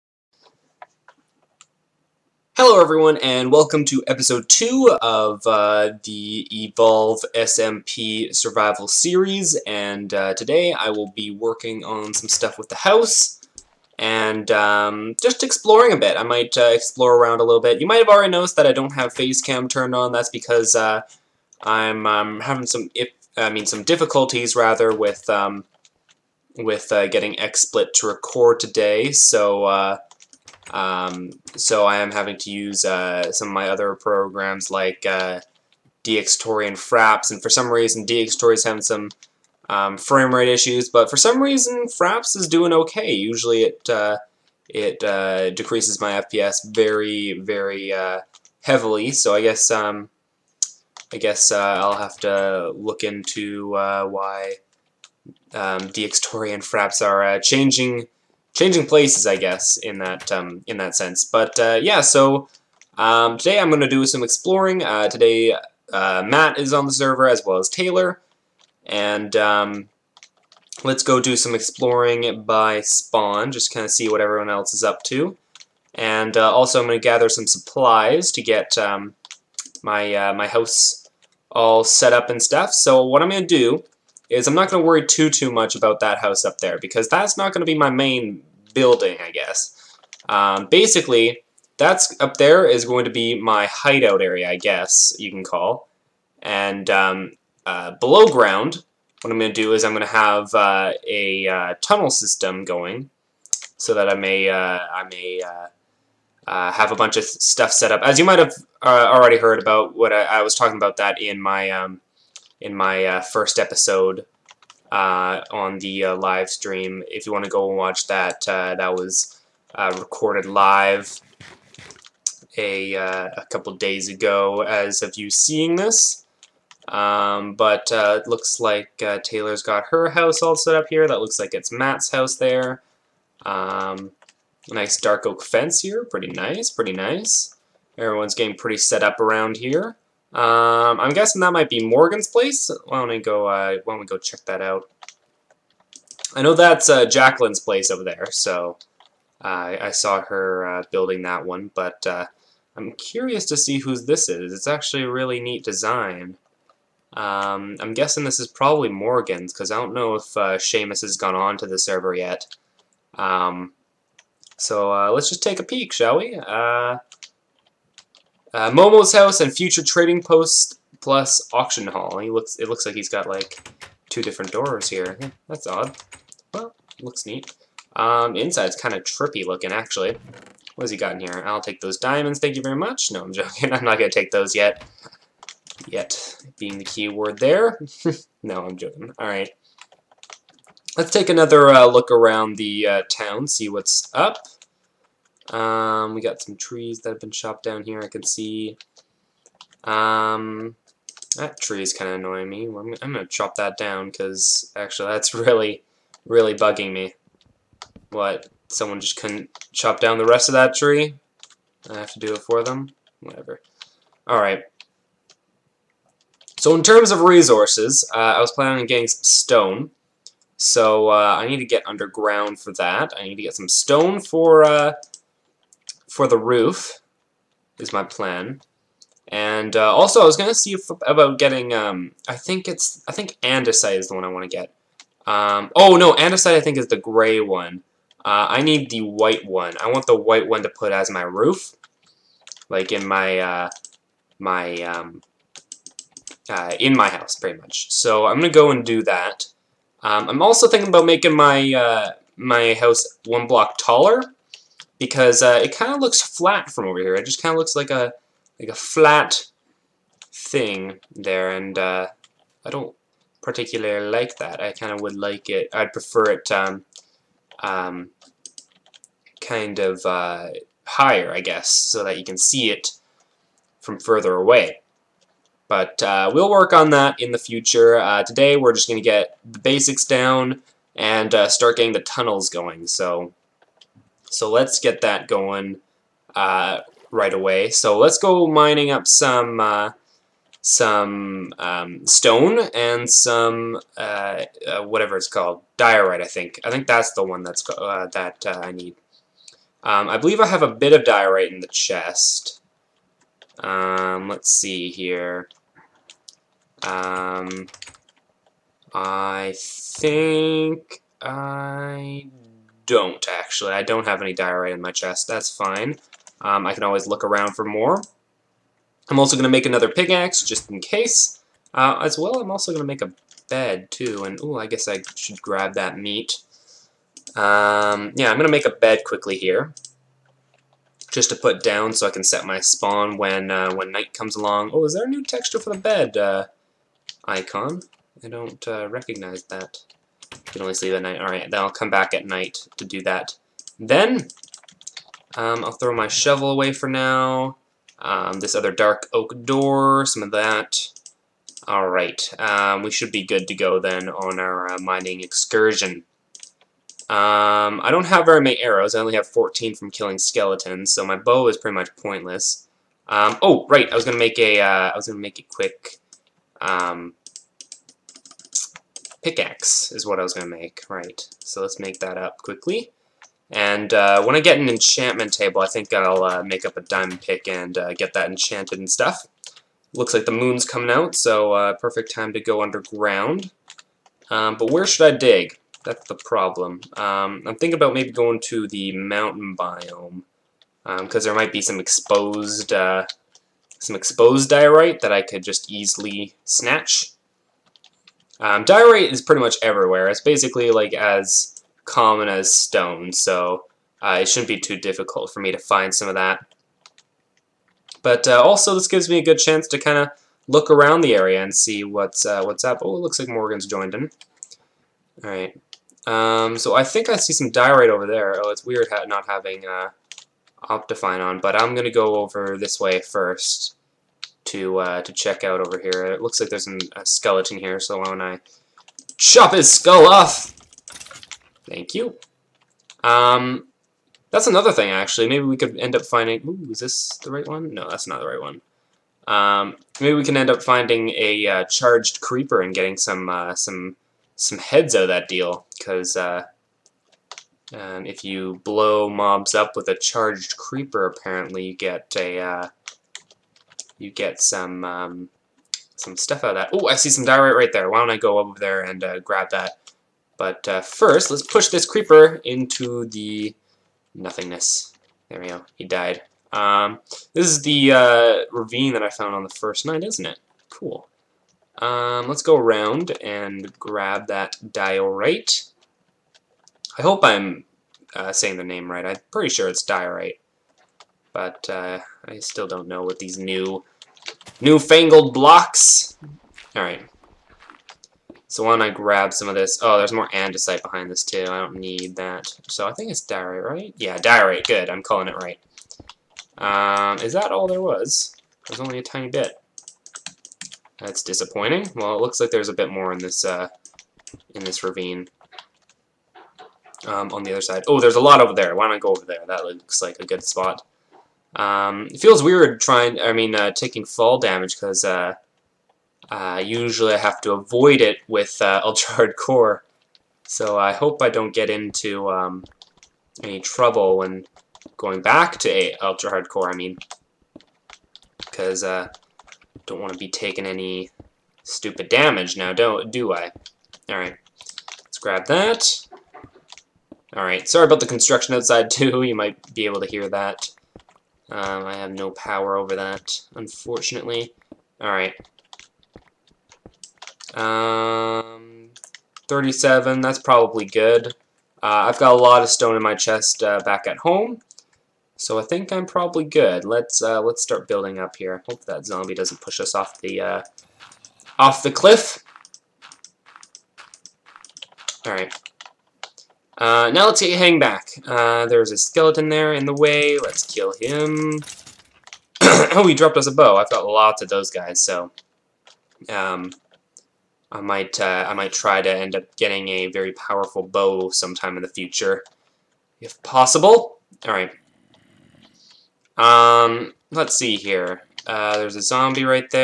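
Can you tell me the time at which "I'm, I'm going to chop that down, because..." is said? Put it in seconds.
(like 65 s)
202 s.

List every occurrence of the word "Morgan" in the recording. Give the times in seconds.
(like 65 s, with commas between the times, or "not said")
141 s, 158 s, 413 s.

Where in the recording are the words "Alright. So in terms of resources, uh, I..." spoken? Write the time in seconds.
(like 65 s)
214 s.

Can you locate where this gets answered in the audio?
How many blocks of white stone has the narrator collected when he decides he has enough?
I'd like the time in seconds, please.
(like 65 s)
549 s.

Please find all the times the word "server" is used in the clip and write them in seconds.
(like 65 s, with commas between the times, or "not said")
66 s, 161 s.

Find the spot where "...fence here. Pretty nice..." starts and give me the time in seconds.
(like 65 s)
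135 s.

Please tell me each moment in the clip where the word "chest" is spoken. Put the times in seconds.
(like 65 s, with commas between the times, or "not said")
301 s, 314 s, 553 s.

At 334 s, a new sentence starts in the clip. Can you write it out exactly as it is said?
Oh, is there a new texture for the bed uh, icon?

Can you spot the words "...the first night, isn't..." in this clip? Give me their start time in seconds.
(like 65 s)
469 s.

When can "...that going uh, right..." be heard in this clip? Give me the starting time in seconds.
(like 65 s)
285 s.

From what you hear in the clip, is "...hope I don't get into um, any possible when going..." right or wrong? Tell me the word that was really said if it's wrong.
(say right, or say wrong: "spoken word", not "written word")
wrong: "trouble", not "possible".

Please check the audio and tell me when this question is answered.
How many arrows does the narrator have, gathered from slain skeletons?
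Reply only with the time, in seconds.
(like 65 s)
359 s.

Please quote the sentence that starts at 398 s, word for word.
Um, diorite is pretty much everywhere.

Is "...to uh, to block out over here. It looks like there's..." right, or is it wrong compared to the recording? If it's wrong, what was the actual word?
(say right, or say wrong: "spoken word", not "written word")
wrong: "check", not "block".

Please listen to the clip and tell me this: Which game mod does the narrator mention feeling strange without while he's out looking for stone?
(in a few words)
Optifine.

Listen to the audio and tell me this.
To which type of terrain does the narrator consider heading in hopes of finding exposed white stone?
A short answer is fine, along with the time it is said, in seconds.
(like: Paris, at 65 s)
Mountain biome, at 388 s.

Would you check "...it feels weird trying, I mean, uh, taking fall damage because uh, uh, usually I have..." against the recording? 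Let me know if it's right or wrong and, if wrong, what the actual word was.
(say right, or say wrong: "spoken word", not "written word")
right.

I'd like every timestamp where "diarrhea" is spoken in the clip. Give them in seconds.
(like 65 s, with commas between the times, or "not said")
314 s.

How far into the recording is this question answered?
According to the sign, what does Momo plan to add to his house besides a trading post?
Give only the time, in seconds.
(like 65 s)
171 s.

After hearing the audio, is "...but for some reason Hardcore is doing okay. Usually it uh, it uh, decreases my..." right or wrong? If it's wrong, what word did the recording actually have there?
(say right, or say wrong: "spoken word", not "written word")
wrong: "Fraps", not "Hardcore".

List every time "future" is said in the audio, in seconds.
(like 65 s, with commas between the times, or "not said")
169 s, 277 s, 581 s.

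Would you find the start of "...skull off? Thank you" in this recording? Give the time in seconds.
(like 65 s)
429 s.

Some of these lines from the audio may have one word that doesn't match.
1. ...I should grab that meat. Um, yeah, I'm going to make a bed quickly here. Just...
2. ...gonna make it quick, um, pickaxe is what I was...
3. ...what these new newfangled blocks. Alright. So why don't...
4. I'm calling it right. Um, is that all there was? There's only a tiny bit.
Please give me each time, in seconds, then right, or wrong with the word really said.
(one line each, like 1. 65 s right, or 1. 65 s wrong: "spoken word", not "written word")
1. 324 s right
2. 365 s right
3. 483 s right
4. 494 s right.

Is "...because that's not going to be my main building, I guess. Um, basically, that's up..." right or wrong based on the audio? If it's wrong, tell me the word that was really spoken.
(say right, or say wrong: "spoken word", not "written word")
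right.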